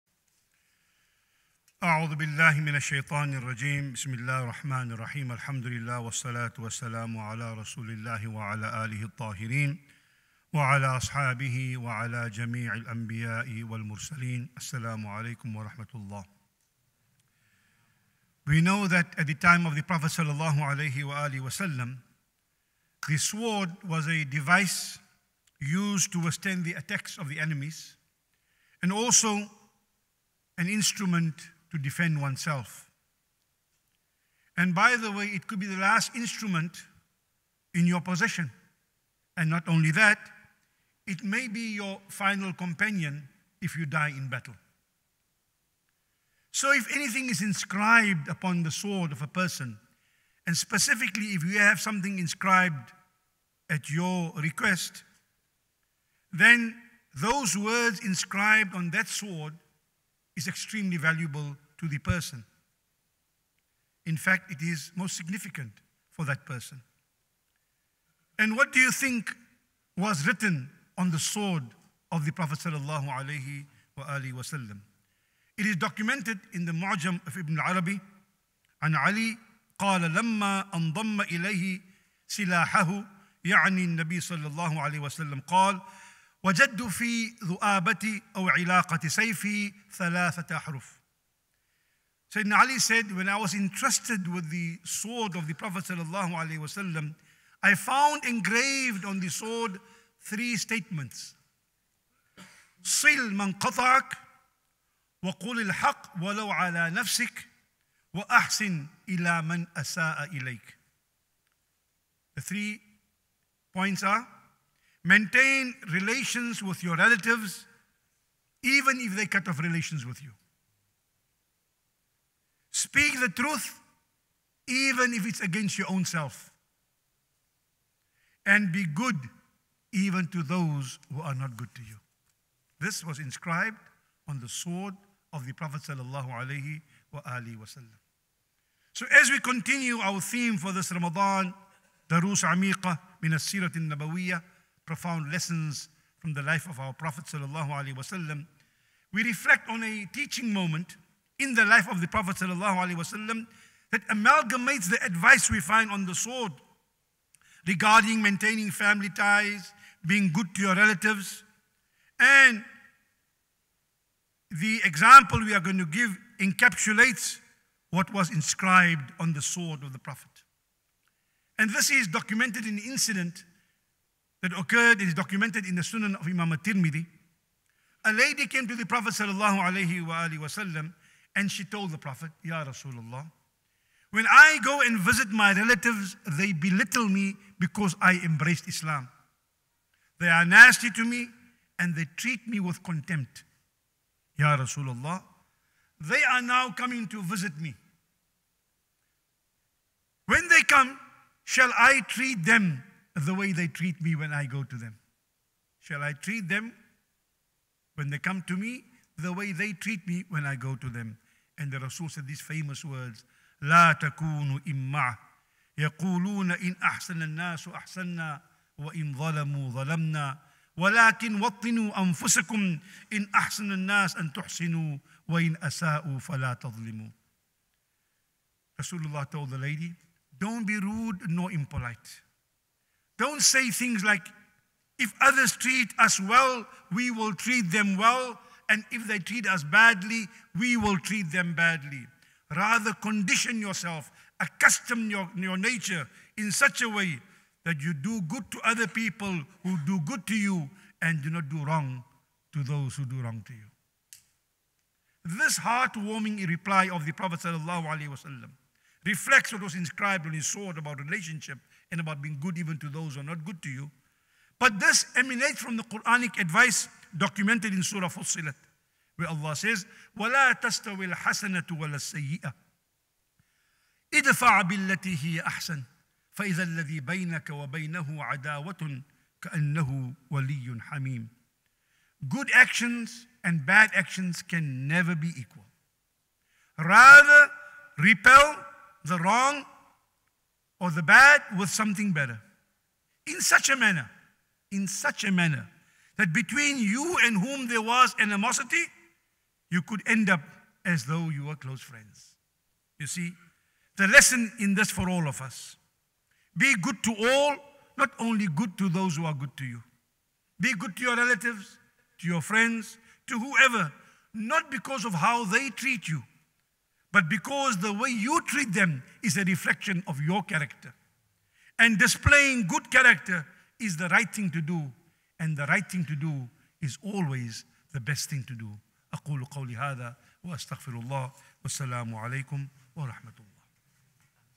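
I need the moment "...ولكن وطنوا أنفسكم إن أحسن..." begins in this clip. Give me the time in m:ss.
3:40.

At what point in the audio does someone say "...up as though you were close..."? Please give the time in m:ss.
5:00.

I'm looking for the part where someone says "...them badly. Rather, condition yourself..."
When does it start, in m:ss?
4:01.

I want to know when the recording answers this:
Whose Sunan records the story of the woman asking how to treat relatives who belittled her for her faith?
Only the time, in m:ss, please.
2:56.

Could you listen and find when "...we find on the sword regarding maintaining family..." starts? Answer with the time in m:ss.
2:35.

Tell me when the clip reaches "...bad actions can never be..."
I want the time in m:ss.
4:43.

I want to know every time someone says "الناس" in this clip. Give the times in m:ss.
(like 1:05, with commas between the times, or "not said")
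3:37, 3:43.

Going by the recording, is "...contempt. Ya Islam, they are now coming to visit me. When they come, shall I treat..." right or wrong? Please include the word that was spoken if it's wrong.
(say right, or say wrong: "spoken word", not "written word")
wrong: "Rasulullah", not "Islam".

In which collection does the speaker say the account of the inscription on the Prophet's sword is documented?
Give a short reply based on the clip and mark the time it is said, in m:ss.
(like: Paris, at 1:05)
Mu'jam of Ibn Arabi, at 1:16.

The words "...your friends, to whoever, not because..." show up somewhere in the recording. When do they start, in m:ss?
5:12.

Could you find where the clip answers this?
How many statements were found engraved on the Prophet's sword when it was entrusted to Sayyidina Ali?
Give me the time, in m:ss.
1:40.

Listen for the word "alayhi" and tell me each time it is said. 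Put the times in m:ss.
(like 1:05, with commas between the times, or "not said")
1:24.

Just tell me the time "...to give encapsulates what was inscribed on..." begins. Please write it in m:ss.
2:45.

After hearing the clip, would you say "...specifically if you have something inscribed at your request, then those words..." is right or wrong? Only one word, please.
right.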